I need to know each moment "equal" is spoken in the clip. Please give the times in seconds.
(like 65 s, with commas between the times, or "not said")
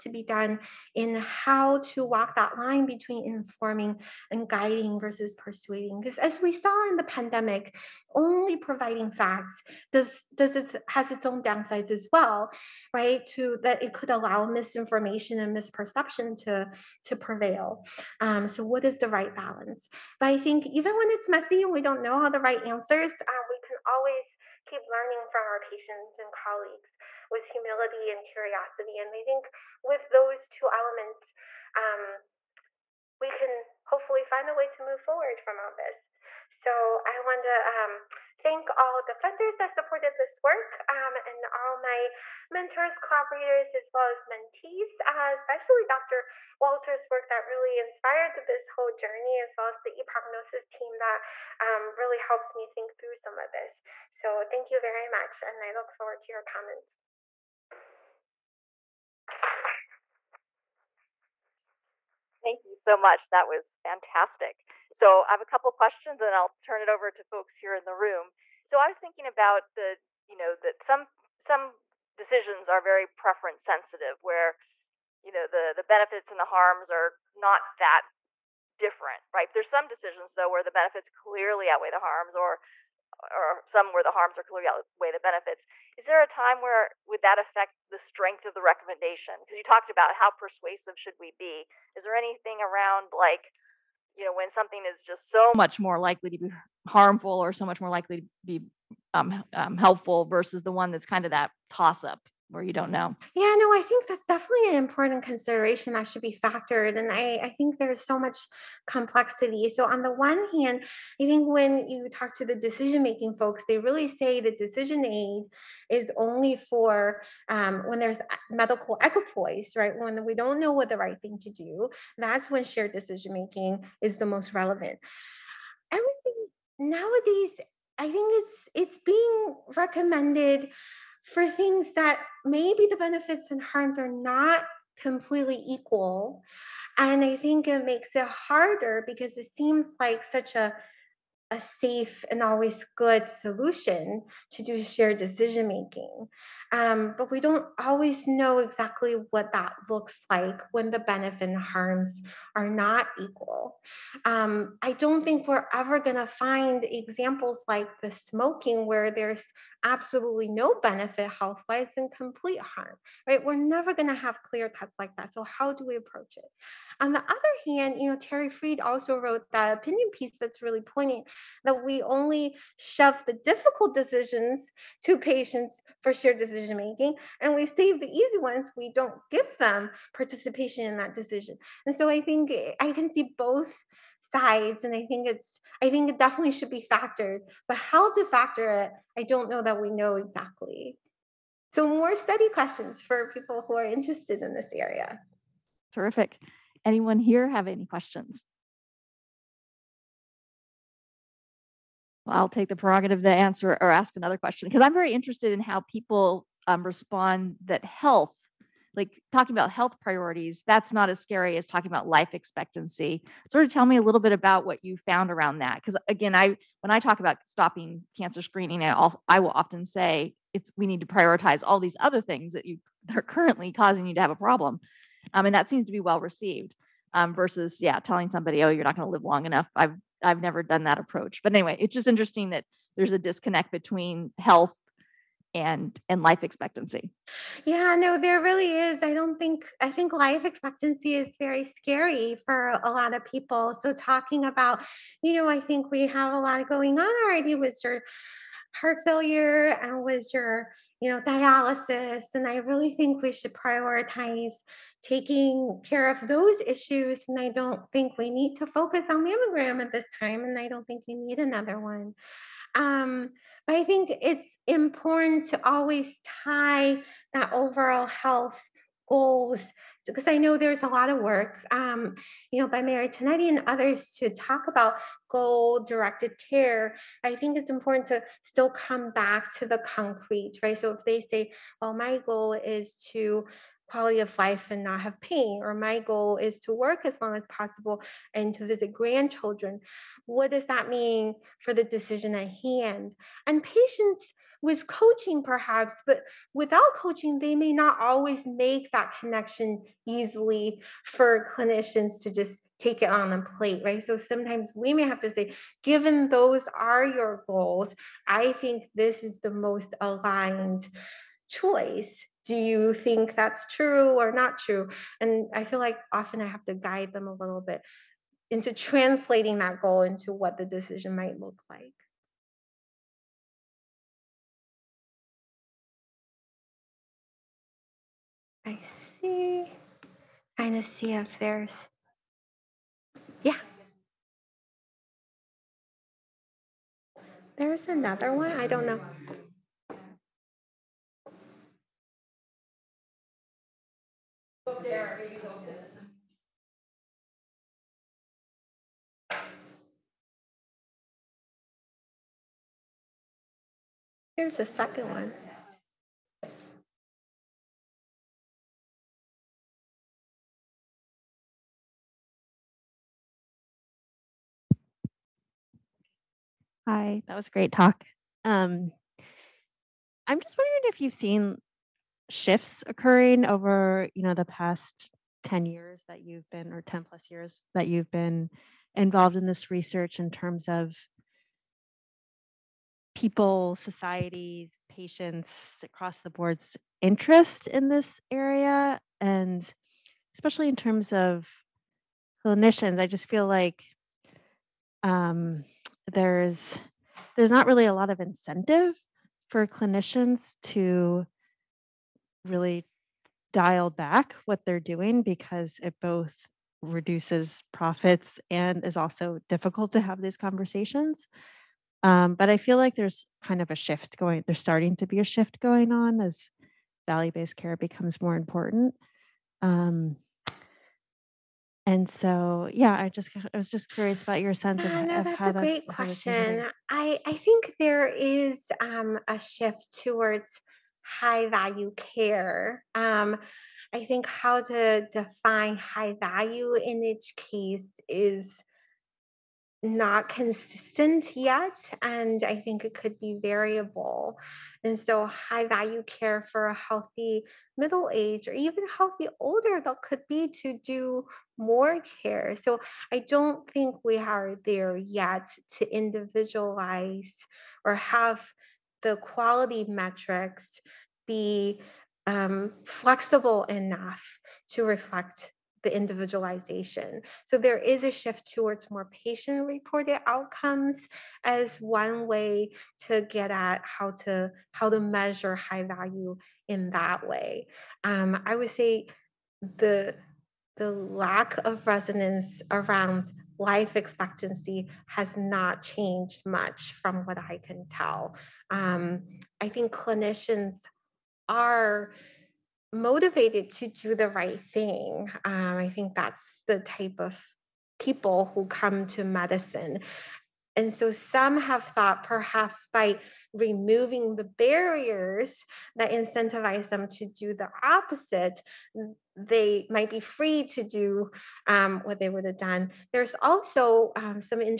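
135 s, 153 s.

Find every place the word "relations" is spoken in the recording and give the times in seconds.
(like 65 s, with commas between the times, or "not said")
not said.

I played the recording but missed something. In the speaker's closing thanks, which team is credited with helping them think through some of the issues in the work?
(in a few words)
ePrognosis.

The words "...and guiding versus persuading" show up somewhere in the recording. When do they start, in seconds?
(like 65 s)
4 s.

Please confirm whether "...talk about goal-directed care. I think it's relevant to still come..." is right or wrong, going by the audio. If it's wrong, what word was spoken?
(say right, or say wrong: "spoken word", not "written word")
wrong: "important", not "relevant".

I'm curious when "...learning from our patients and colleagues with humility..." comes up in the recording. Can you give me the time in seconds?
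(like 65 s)
24 s.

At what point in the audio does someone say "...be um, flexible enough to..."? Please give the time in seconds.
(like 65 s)
461 s.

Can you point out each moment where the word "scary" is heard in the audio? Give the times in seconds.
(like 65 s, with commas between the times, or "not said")
211 s, 241 s.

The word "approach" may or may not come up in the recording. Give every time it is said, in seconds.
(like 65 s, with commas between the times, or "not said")
165 s, 230 s.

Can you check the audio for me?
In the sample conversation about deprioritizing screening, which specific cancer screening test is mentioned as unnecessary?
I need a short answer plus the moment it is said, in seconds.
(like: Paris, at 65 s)
mammogram, at 259 s.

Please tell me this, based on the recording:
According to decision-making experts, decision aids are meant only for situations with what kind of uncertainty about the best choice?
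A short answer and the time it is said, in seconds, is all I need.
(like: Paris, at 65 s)
medical equipoise, at 118 s.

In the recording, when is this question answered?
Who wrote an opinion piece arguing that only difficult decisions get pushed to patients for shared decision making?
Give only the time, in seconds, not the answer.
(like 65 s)
168 s.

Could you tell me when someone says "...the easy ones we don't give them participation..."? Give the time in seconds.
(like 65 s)
178 s.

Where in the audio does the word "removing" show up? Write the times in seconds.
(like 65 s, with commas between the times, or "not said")
503 s.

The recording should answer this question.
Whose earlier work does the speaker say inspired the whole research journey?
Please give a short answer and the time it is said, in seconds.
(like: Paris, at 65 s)
Dr. Walter, at 45 s.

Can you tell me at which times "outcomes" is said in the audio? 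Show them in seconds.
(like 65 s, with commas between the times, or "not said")
470 s.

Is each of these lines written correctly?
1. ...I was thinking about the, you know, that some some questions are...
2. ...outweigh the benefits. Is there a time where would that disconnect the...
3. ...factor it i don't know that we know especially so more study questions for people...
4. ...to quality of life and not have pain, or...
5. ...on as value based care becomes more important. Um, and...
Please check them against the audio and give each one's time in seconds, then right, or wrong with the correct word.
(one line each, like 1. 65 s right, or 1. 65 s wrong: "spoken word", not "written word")
1. 68 s wrong: "decisions", not "questions"
2. 84 s wrong: "affect", not "disconnect"
3. 188 s wrong: "exactly", not "especially"
4. 283 s right
5. 415 s right.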